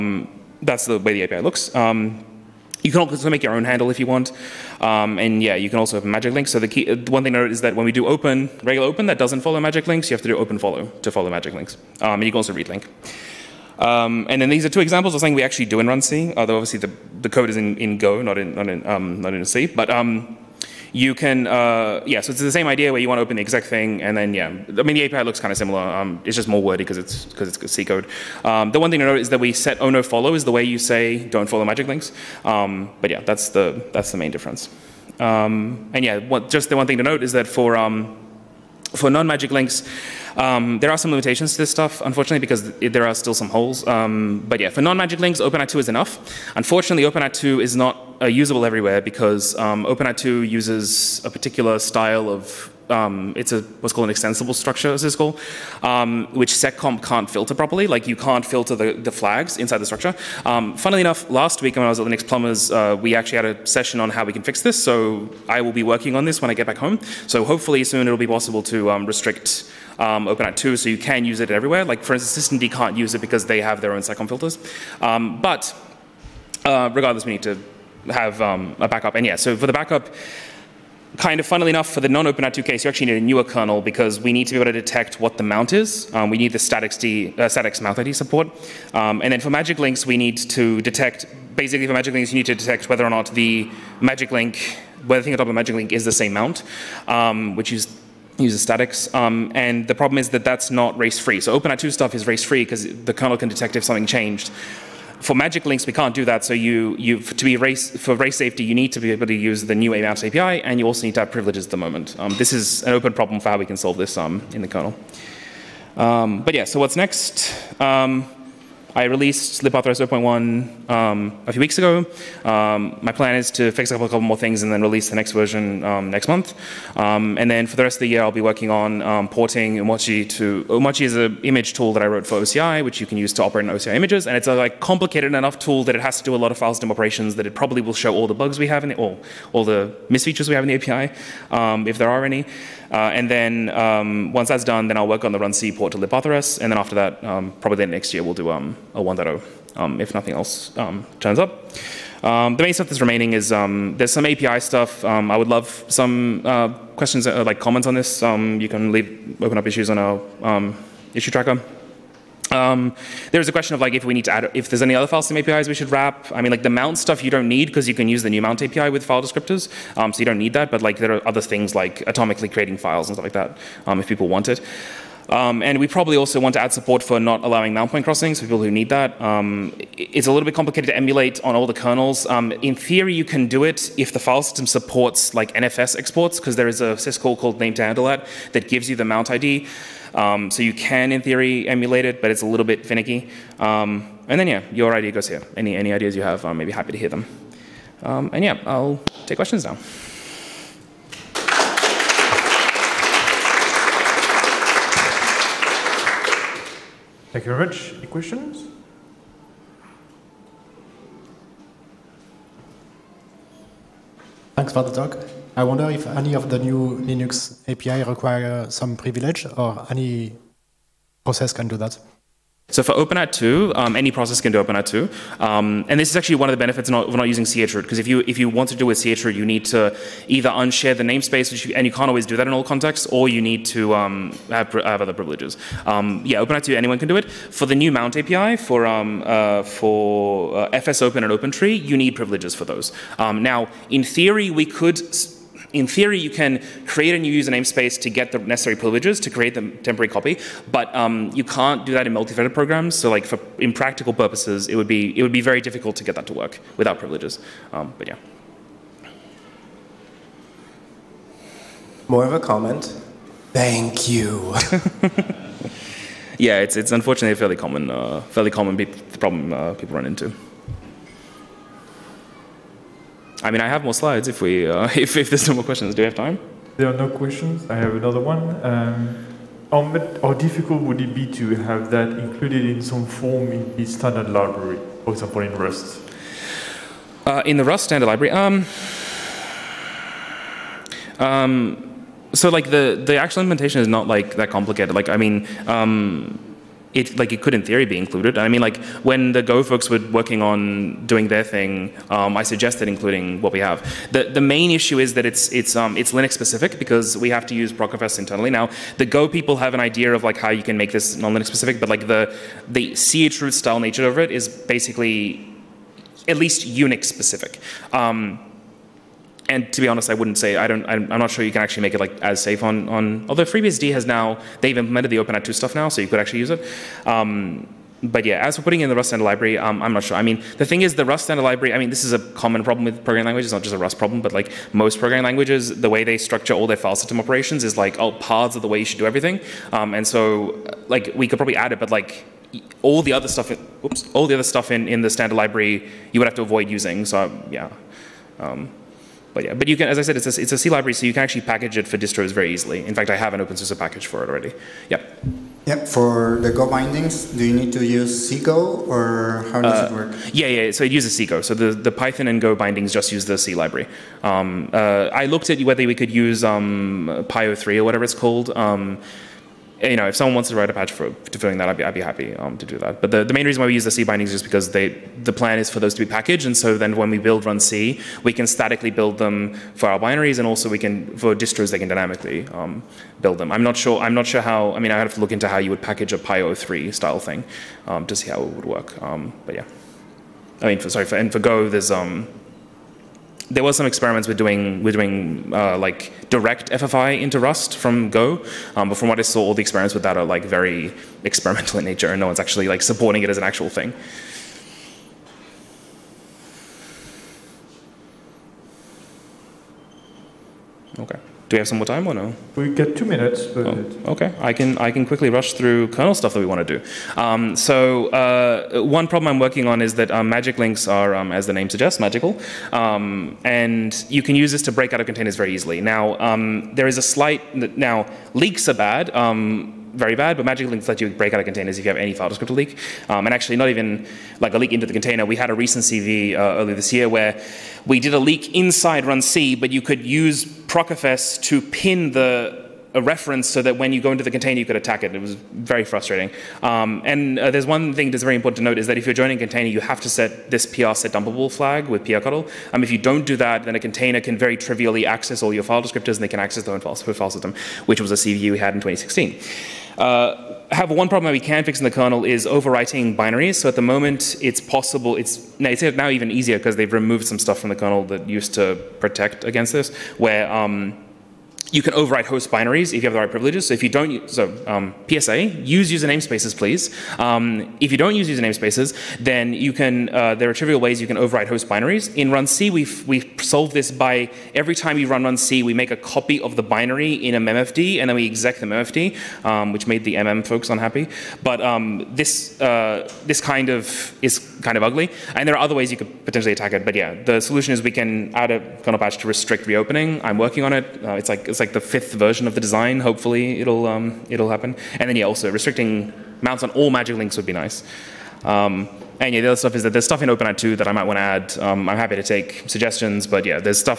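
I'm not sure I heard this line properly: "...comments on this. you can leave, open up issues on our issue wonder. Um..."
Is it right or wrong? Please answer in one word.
wrong.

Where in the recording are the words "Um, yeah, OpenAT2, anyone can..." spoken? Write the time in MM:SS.
03:55.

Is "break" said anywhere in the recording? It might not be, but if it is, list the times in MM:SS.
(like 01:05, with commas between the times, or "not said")
07:04, 07:11.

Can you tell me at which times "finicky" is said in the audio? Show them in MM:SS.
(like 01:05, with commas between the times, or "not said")
03:12.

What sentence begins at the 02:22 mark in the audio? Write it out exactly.
Uh, and then um, once that's done, then I'll work on the run C port to libpathrs.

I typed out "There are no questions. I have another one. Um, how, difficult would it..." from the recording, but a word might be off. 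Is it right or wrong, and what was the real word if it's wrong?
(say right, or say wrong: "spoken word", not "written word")
right.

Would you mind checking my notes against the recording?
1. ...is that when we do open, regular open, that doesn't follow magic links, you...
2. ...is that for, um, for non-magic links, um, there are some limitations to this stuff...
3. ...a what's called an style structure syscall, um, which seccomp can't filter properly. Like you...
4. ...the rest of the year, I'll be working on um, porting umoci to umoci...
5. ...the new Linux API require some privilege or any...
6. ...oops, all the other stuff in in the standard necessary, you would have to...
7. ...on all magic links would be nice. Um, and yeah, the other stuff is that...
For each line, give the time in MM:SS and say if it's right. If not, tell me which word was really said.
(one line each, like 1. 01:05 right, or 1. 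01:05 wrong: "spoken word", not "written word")
1. 00:07 right
2. 00:37 right
3. 00:53 wrong: "extensible", not "style"
4. 02:07 right
5. 03:36 right
6. 05:43 wrong: "library", not "necessary"
7. 08:26 right.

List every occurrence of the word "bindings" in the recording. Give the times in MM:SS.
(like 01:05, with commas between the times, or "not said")
05:56, 06:02, 06:14.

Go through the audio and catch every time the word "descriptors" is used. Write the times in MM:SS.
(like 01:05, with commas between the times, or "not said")
02:49, 07:12, 07:35.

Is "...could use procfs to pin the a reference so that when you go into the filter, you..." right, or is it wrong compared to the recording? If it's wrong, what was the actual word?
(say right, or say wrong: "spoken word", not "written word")
wrong: "container", not "filter".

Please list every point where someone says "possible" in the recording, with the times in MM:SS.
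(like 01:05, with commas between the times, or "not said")
01:08, 07:44.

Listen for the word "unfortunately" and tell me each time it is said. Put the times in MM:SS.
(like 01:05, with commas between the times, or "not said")
00:42, 00:46, 04:26.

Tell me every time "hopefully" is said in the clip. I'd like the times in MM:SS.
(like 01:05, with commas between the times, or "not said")
01:07, 08:22.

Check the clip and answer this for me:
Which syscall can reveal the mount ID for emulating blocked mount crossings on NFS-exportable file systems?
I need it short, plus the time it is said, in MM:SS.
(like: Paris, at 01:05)
name to handle, at 03:07.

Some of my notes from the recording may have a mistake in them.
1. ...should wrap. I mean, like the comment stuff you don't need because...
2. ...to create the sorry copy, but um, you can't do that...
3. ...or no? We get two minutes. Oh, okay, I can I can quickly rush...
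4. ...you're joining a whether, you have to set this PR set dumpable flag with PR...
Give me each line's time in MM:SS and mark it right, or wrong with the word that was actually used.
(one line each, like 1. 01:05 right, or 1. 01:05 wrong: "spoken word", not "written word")
1. 02:45 wrong: "mount", not "comment"
2. 04:09 wrong: "temporary", not "sorry"
3. 06:52 right
4. 07:29 wrong: "container", not "whether".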